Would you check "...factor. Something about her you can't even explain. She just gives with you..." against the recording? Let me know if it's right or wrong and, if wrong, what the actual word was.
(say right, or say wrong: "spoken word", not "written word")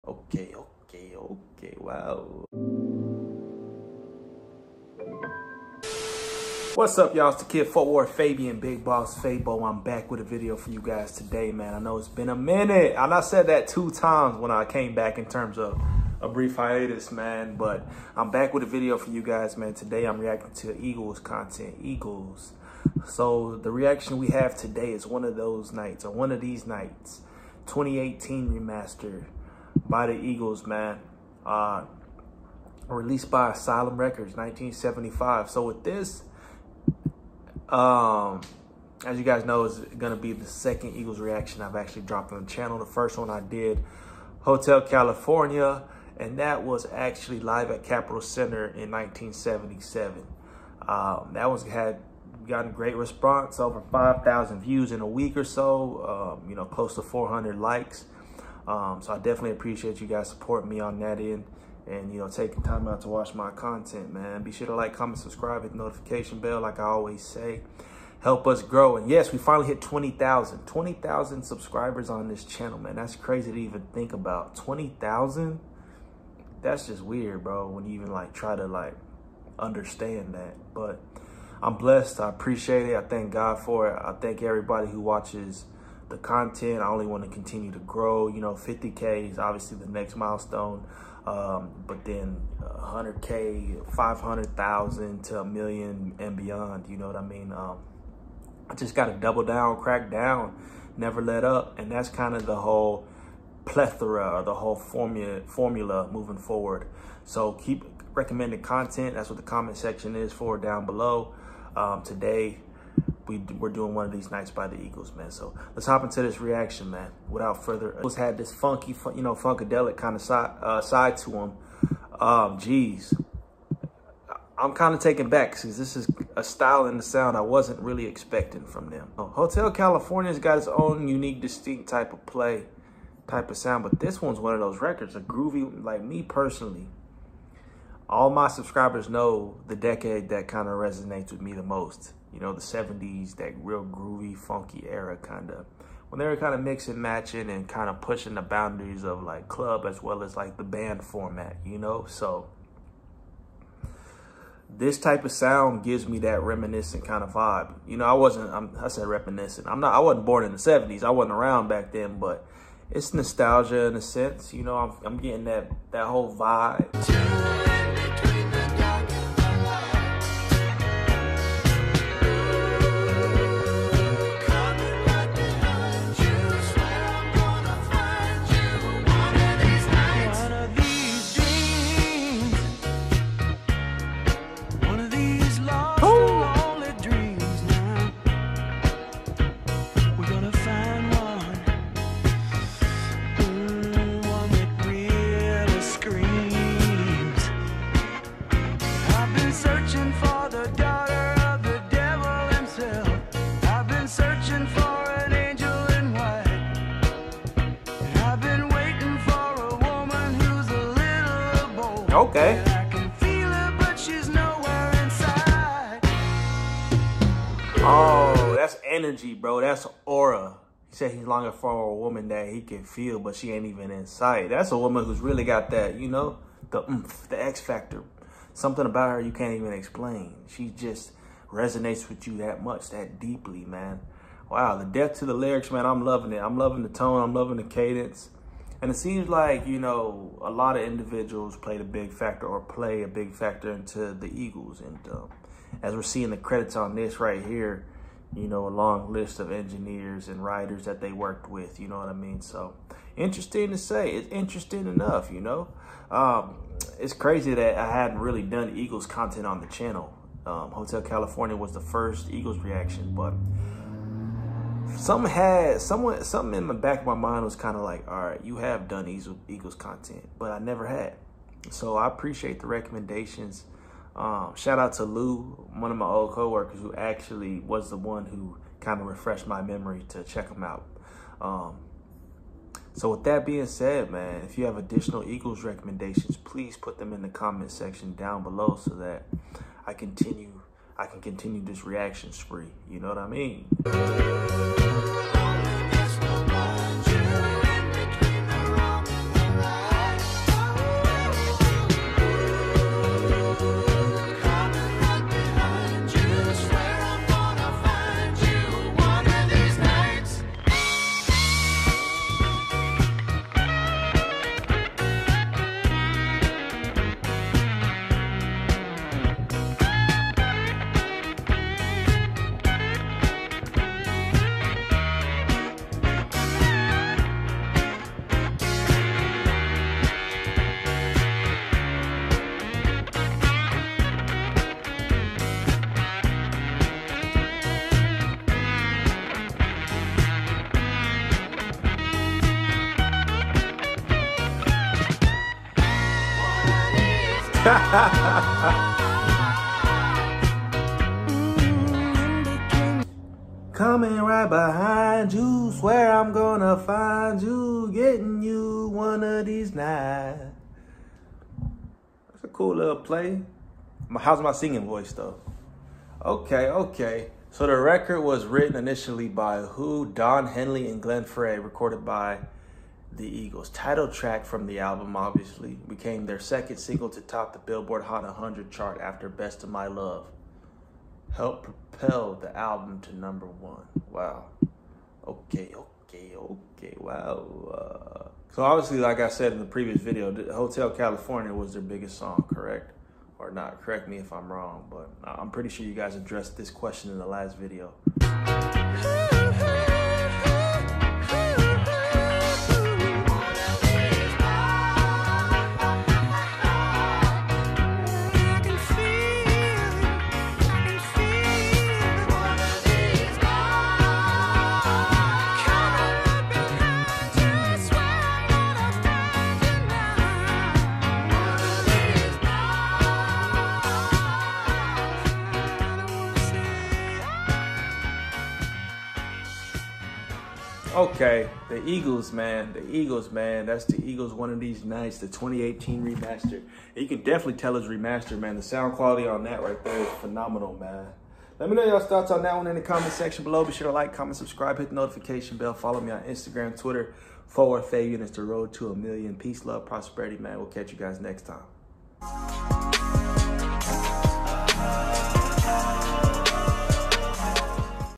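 wrong: "resonates", not "gives".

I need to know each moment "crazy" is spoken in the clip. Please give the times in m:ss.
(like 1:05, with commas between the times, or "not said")
1:13, 4:17.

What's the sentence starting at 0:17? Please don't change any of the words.
But I'm back with a video for you guys, man.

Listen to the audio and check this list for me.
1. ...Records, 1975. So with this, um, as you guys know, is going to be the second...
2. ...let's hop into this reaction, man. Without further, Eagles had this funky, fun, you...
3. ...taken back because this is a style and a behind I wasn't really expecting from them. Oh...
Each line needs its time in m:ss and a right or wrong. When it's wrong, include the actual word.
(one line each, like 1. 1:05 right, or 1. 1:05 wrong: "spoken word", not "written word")
1. 0:33 right
2. 1:55 right
3. 2:05 wrong: "sound", not "behind".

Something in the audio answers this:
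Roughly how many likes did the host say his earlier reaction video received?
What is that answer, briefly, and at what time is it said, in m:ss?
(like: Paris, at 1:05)
400, at 0:57.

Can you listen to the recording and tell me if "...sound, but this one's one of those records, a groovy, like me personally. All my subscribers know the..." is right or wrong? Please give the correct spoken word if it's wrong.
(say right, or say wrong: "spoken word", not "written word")
right.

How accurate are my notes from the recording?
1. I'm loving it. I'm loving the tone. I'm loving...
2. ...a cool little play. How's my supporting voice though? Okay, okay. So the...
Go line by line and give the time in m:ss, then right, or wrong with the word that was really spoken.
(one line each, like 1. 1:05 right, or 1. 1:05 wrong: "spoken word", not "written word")
1. 3:55 right
2. 6:02 wrong: "singing", not "supporting".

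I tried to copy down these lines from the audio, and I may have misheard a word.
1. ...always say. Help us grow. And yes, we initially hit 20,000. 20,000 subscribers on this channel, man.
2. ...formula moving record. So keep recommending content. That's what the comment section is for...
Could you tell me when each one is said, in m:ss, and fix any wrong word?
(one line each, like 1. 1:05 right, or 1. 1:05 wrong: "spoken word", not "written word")
1. 1:06 wrong: "finally", not "initially"
2. 1:45 wrong: "forward", not "record".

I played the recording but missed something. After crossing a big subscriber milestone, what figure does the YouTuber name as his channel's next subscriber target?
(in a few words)
50K.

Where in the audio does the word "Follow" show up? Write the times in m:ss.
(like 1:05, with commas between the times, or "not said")
7:25.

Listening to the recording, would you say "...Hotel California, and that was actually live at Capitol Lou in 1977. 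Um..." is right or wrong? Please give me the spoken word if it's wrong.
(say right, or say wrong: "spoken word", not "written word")
wrong: "Center", not "Lou".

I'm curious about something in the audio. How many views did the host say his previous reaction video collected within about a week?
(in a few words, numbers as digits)
5,000.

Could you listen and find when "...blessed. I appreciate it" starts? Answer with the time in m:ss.
1:21.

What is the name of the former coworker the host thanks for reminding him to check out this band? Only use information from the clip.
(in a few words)
Lou.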